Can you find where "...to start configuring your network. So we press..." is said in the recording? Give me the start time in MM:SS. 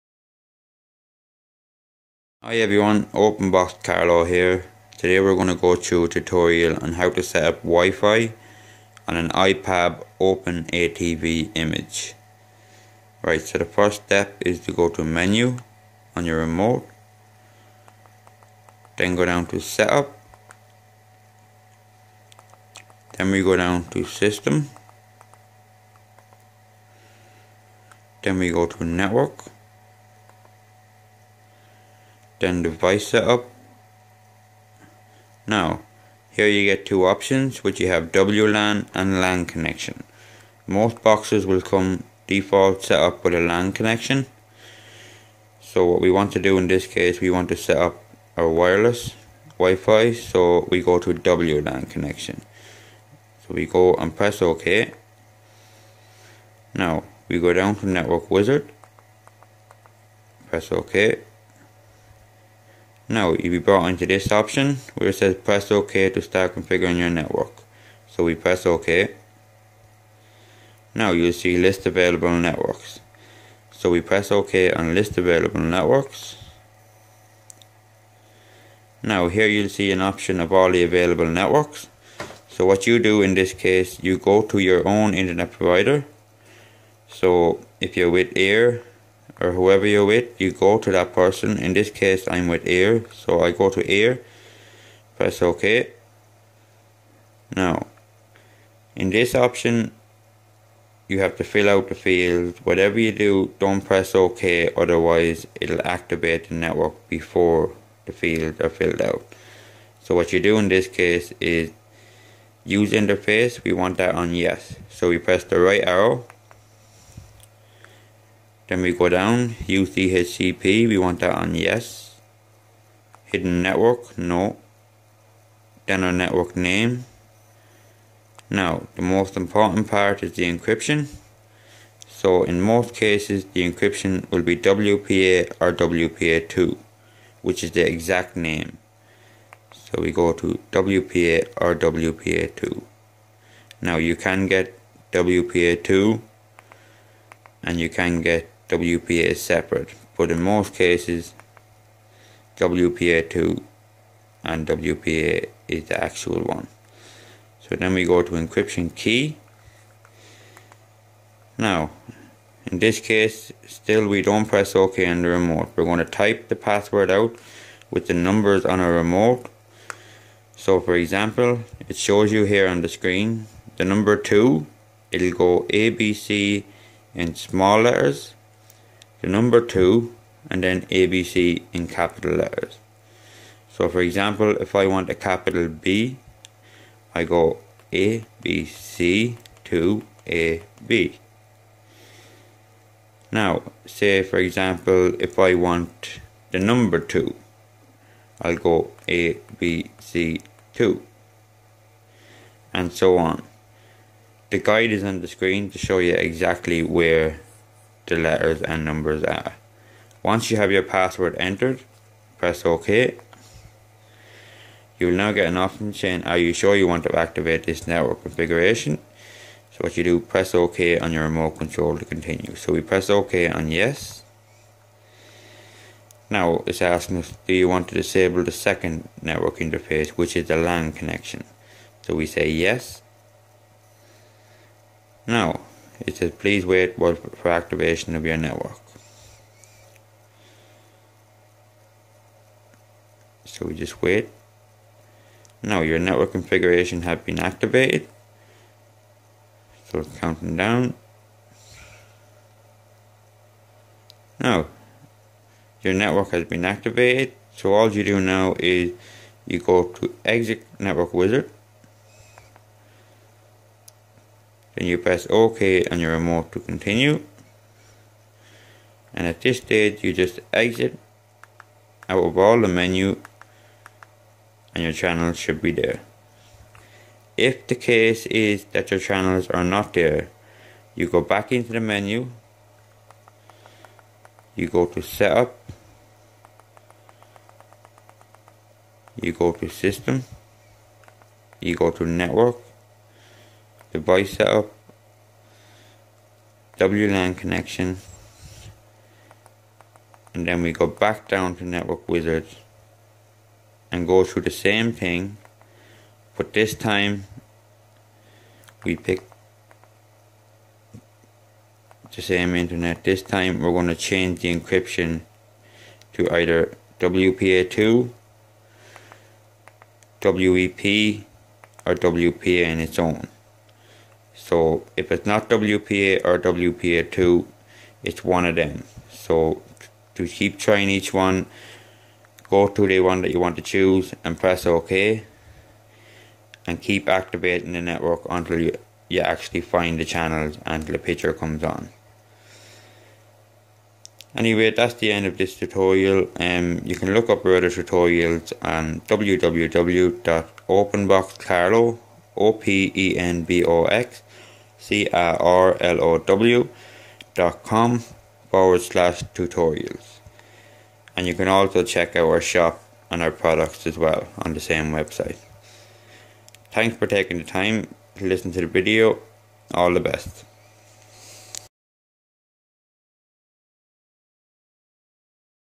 01:06.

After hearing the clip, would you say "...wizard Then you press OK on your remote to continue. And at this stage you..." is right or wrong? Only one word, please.
right.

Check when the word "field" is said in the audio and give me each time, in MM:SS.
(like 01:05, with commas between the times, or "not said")
01:41, 01:48.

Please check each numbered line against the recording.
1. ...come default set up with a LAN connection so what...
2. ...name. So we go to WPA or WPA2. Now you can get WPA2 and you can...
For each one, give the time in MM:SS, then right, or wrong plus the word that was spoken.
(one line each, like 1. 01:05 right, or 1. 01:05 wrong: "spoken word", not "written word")
1. 00:41 right
2. 02:18 right.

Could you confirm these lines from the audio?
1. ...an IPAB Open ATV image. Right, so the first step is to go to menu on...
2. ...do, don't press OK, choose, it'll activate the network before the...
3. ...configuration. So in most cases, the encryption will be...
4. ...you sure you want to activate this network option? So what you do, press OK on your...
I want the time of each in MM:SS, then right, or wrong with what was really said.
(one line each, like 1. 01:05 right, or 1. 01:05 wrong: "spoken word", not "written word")
1. 00:09 right
2. 01:43 wrong: "otherwise", not "choose"
3. 02:10 wrong: "encryption", not "configuration"
4. 03:36 wrong: "configuration", not "option".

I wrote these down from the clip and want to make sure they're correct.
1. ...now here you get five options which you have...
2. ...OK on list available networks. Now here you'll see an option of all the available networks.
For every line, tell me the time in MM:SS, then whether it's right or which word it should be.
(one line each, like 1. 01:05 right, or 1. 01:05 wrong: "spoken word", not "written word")
1. 00:35 wrong: "two", not "five"
2. 01:14 right.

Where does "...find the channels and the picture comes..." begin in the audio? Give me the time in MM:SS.
05:39.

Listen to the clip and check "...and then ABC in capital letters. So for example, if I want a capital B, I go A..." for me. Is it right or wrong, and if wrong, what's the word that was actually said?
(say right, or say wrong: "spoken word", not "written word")
right.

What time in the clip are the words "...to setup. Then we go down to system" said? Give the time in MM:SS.
00:19.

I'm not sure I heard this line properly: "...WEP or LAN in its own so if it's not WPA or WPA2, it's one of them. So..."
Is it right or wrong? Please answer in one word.
wrong.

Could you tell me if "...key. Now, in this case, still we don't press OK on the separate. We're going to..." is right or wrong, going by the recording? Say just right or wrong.
wrong.